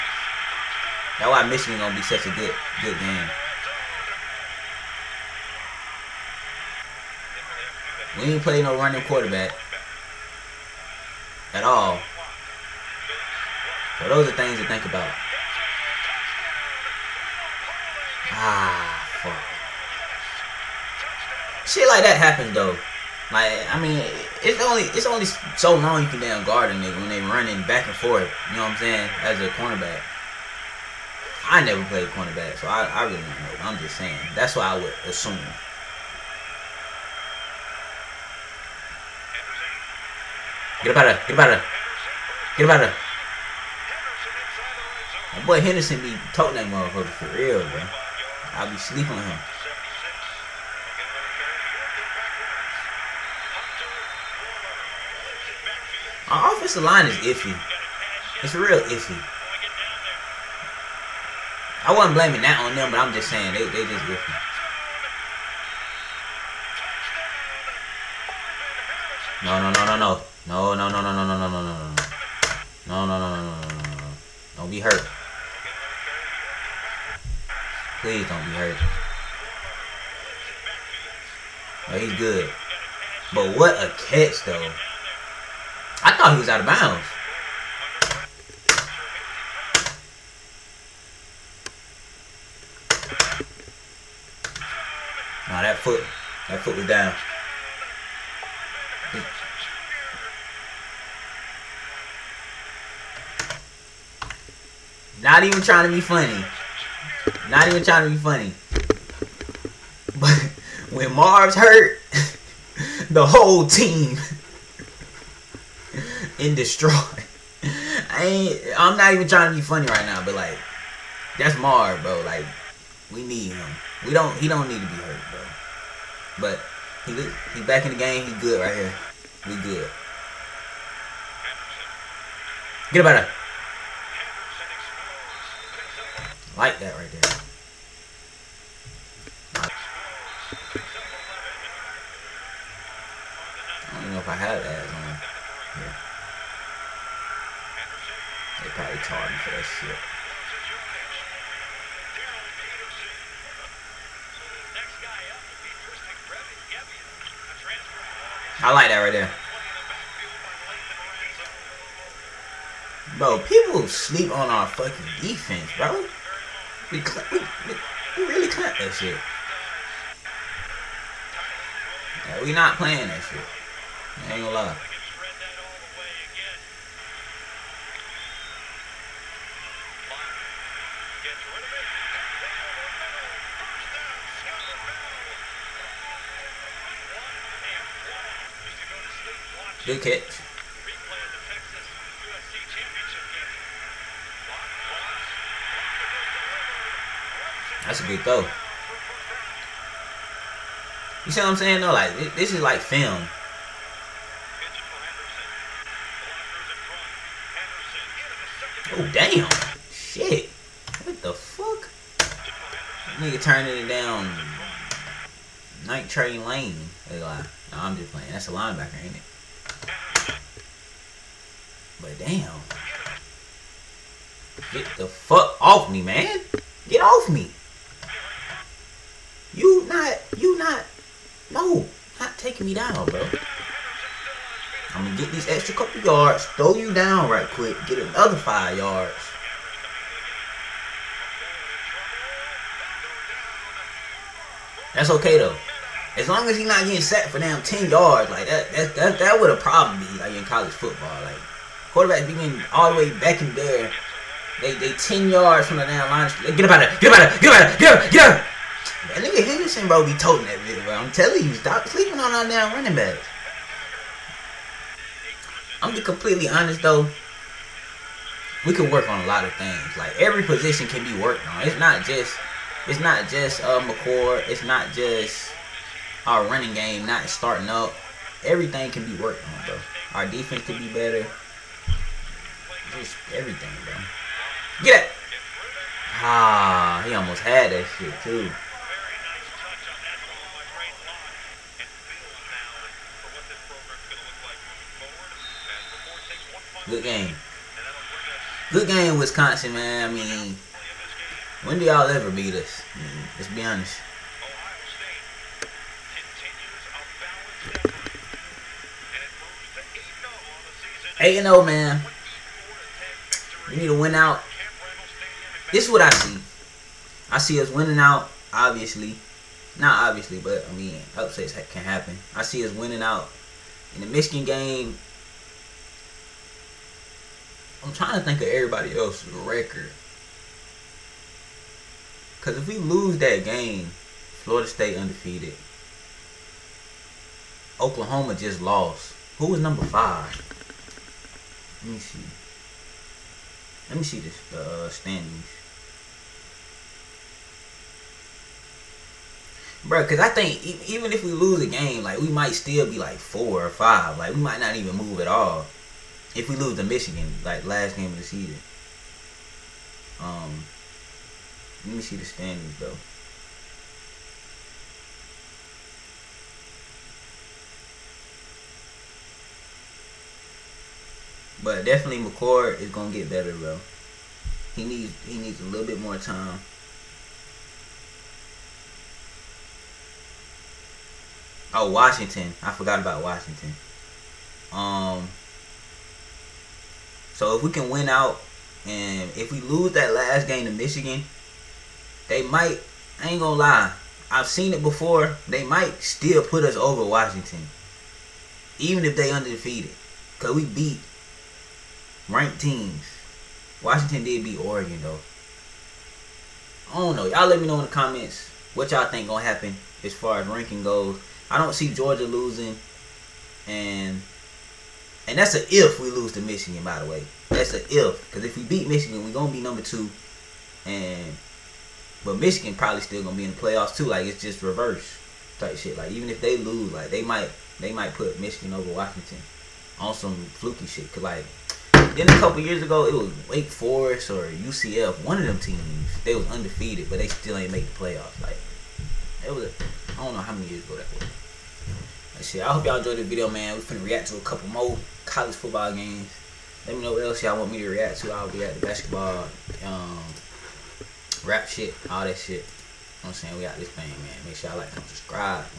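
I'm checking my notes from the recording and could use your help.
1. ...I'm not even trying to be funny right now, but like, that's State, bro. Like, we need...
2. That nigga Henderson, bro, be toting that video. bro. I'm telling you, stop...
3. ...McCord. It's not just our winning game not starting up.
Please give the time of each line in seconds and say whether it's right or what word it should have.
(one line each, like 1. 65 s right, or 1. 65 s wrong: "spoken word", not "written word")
1. 118 s wrong: "Mar", not "State"
2. 259 s right
3. 273 s wrong: "running", not "winning".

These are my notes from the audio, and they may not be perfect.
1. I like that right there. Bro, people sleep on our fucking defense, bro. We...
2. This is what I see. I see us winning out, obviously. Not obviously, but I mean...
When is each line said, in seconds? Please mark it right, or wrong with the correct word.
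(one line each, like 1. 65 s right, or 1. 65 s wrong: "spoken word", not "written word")
1. 158 s right
2. 315 s right.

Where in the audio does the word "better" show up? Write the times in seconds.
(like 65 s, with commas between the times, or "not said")
280 s, 373 s.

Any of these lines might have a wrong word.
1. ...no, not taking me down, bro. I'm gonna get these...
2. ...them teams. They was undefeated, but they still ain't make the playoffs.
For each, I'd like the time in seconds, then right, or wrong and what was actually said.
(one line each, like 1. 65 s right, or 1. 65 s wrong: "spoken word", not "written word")
1. 231 s right
2. 435 s right.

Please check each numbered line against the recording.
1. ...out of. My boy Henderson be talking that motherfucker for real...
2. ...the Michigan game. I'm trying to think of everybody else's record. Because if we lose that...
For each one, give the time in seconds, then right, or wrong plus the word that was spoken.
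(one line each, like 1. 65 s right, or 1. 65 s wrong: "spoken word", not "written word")
1. 42 s right
2. 323 s right.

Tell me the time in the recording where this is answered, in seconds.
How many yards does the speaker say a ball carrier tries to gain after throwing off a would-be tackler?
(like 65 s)
238 s.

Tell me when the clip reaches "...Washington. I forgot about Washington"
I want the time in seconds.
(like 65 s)
381 s.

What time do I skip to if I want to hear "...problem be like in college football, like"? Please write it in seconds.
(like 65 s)
249 s.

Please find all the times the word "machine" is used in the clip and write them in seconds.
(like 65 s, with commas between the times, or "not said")
not said.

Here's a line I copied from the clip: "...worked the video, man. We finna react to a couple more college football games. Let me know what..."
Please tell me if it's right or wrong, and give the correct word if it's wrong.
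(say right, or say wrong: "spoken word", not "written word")
wrong: "enjoyed", not "worked".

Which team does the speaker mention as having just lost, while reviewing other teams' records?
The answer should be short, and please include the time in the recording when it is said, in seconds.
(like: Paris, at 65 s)
Oklahoma, at 337 s.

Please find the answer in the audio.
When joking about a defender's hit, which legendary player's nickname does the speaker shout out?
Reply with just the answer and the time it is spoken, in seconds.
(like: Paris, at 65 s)
Night Train Lane, at 215 s.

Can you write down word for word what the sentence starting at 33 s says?
I'm just saying that's what I would assume.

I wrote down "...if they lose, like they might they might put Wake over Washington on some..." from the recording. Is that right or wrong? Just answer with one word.
wrong.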